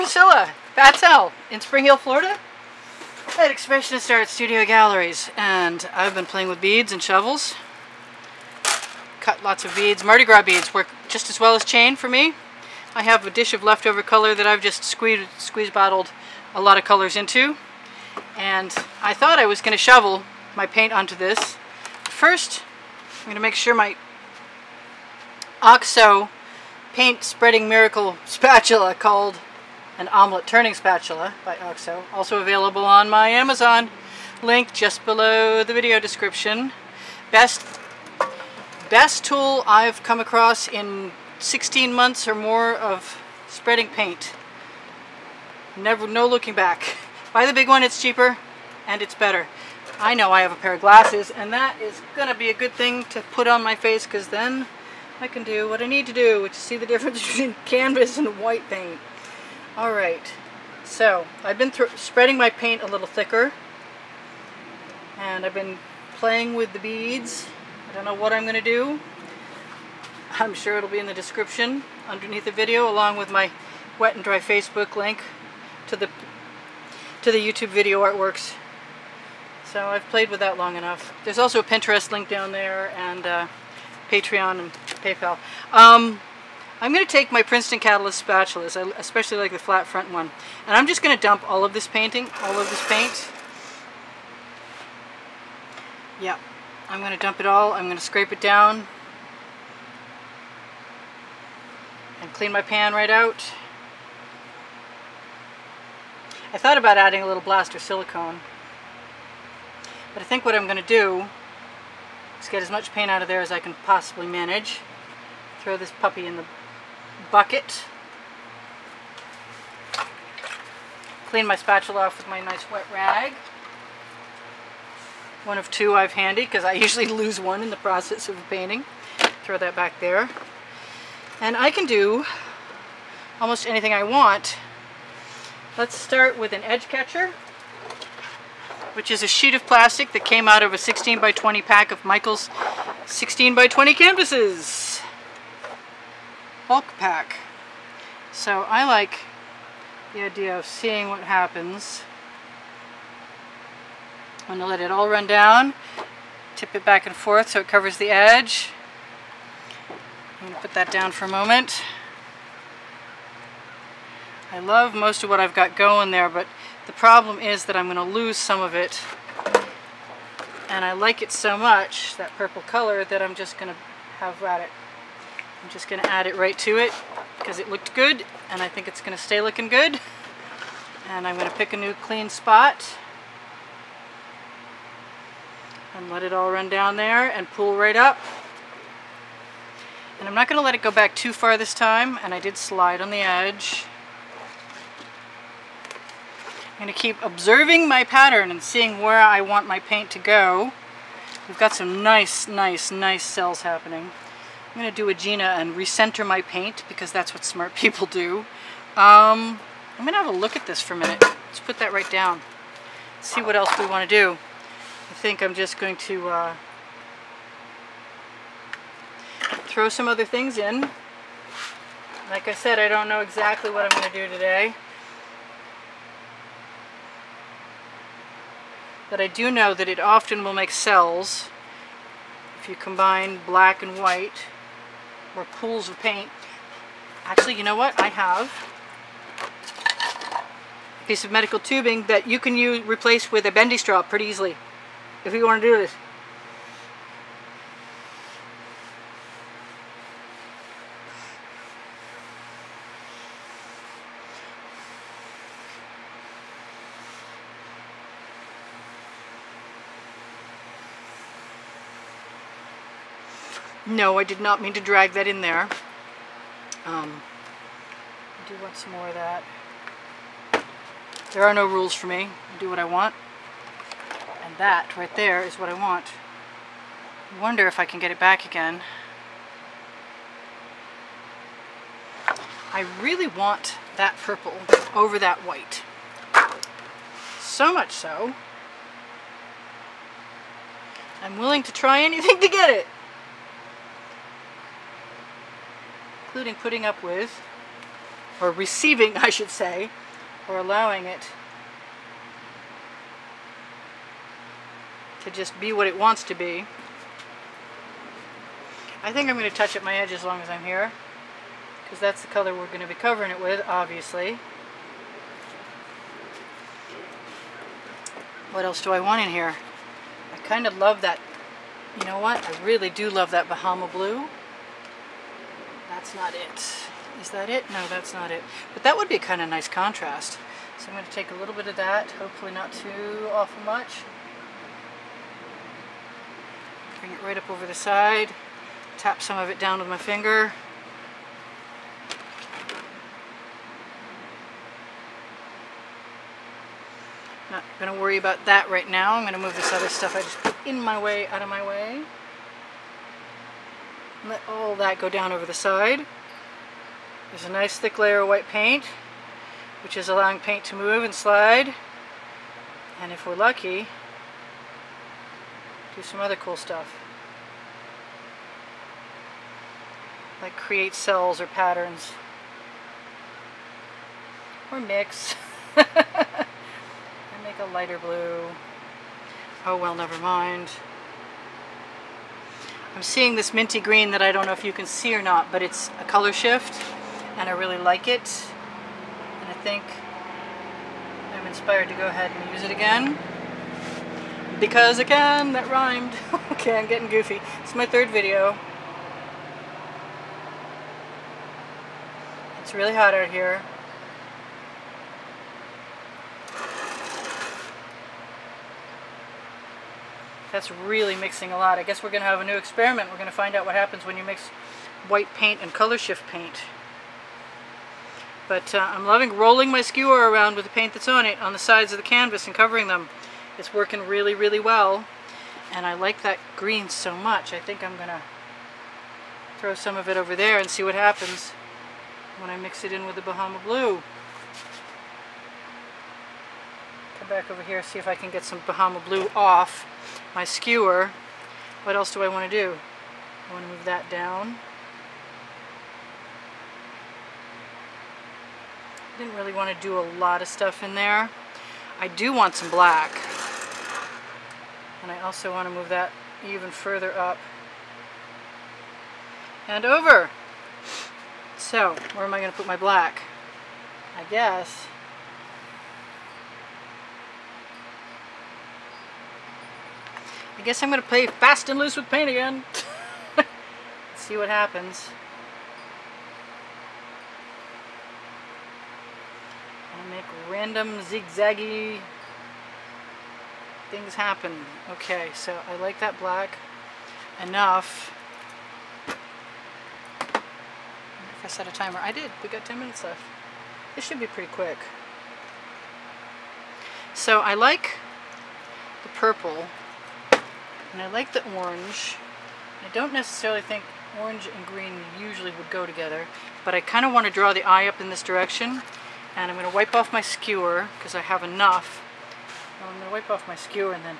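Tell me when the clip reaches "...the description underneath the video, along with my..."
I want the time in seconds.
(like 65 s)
71 s.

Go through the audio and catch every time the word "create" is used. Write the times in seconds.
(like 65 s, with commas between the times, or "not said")
370 s.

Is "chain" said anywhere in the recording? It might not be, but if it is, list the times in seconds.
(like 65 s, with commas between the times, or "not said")
11 s.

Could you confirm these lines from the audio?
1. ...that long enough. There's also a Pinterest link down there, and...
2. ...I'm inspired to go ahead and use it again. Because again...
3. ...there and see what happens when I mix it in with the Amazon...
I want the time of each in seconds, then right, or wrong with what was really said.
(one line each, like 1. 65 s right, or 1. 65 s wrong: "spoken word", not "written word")
1. 80 s right
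2. 391 s right
3. 430 s wrong: "Bahama", not "Amazon".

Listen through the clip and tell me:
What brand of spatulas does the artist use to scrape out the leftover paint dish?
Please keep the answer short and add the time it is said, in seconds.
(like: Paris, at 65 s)
Princeton Catalyst, at 87 s.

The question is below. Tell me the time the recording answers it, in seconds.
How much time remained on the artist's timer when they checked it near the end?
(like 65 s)
492 s.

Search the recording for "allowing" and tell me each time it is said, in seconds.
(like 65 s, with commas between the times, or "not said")
300 s, 360 s.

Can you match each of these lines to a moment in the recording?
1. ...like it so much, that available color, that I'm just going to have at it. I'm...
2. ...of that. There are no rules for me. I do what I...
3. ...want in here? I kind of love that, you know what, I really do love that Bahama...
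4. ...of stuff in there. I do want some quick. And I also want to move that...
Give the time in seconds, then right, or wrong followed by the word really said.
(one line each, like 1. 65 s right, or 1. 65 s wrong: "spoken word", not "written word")
1. 170 s wrong: "purple", not "available"
2. 269 s right
3. 318 s right
4. 450 s wrong: "black", not "quick".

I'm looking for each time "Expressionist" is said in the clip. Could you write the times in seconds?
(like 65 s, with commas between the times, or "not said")
3 s.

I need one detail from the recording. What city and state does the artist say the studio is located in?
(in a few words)
Spring Hill, Florida.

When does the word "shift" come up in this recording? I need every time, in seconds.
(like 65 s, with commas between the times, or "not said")
386 s, 415 s.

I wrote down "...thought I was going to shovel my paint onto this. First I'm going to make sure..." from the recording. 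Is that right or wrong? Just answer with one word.
right.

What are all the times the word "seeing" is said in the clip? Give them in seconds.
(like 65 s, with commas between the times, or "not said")
150 s, 198 s, 383 s.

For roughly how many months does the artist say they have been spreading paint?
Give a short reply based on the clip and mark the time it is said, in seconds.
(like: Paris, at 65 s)
16 months, at 41 s.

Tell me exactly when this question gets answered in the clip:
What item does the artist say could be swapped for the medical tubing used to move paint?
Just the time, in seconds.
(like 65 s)
243 s.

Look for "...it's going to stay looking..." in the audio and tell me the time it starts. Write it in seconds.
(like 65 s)
178 s.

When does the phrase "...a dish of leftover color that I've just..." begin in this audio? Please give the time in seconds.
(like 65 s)
13 s.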